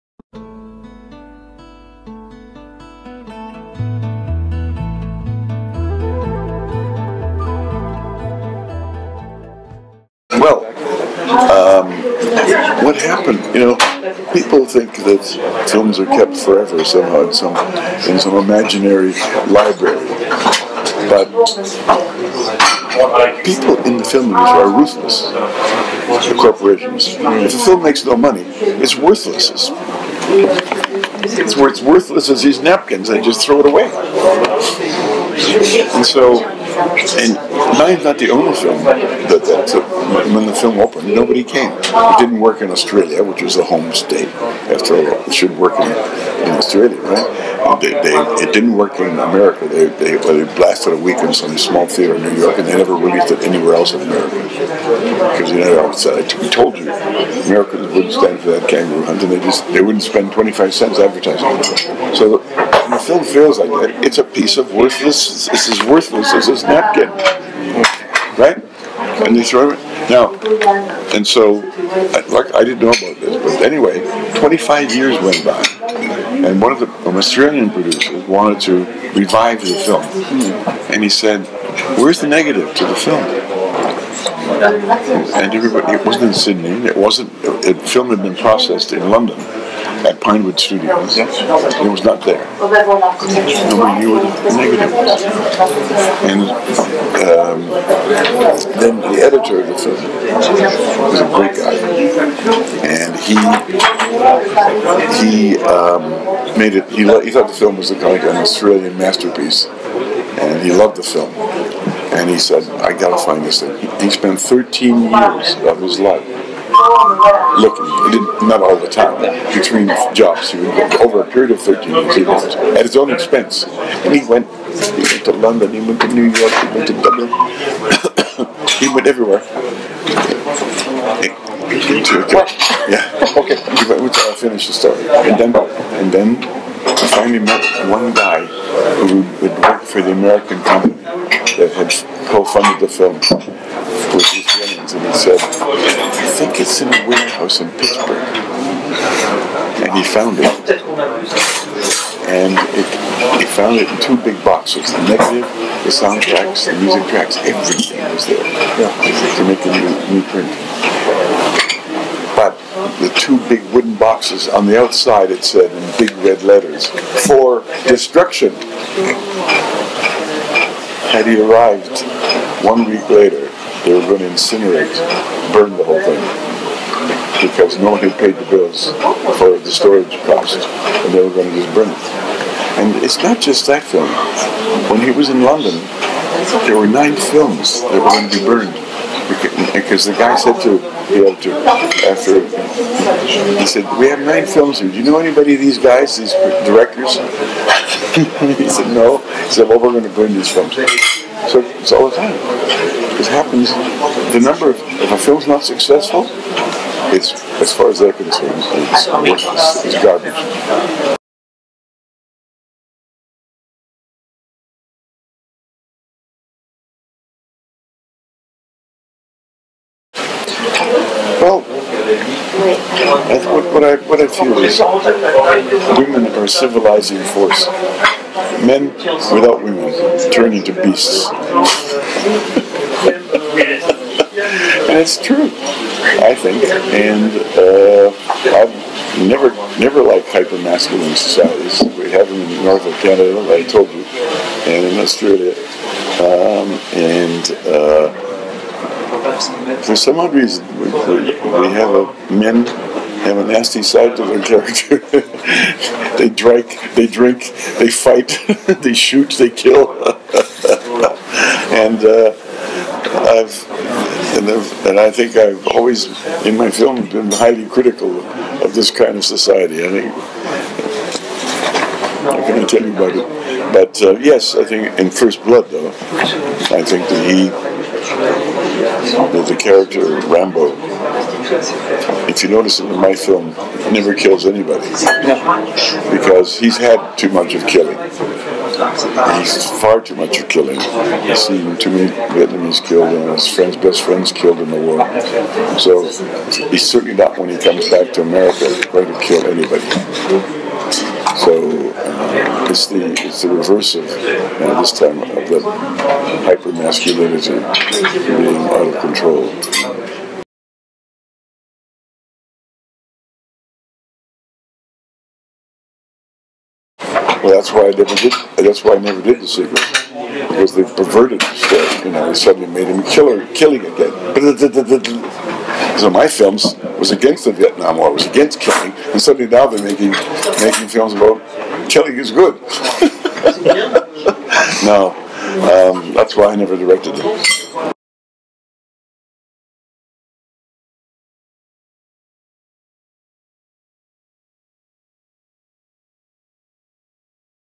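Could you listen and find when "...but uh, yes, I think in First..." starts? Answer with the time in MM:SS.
04:33.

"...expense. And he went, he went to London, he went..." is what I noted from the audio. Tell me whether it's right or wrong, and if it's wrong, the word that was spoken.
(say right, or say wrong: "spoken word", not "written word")
right.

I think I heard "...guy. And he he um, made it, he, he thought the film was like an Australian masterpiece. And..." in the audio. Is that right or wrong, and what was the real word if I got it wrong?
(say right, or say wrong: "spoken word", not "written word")
right.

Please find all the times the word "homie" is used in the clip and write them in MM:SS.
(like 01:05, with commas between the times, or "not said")
not said.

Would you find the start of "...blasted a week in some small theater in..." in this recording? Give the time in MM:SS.
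00:50.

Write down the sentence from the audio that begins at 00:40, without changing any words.
When the film opened, nobody came.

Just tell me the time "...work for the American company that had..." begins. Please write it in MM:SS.
02:19.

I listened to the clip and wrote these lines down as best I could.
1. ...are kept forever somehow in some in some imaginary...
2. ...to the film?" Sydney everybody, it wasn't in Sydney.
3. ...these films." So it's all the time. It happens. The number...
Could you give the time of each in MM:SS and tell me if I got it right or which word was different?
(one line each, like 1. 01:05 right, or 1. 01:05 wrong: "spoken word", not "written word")
1. 00:15 right
2. 01:22 wrong: "And", not "Sydney"
3. 03:20 right.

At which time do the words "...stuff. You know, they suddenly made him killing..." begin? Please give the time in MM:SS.
05:21.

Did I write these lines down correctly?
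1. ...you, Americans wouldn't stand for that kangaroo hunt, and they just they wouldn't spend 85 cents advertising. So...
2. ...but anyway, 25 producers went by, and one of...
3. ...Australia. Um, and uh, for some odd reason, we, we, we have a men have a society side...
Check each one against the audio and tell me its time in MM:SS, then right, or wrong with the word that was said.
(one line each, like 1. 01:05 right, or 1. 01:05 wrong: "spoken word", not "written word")
1. 00:56 wrong: "25", not "85"
2. 01:13 wrong: "years", not "producers"
3. 04:04 wrong: "nasty", not "society".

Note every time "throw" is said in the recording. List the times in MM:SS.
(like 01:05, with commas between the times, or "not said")
00:33, 01:09.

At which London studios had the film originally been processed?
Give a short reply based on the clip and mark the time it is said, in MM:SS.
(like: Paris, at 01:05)
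Pinewood Studios, at 01:30.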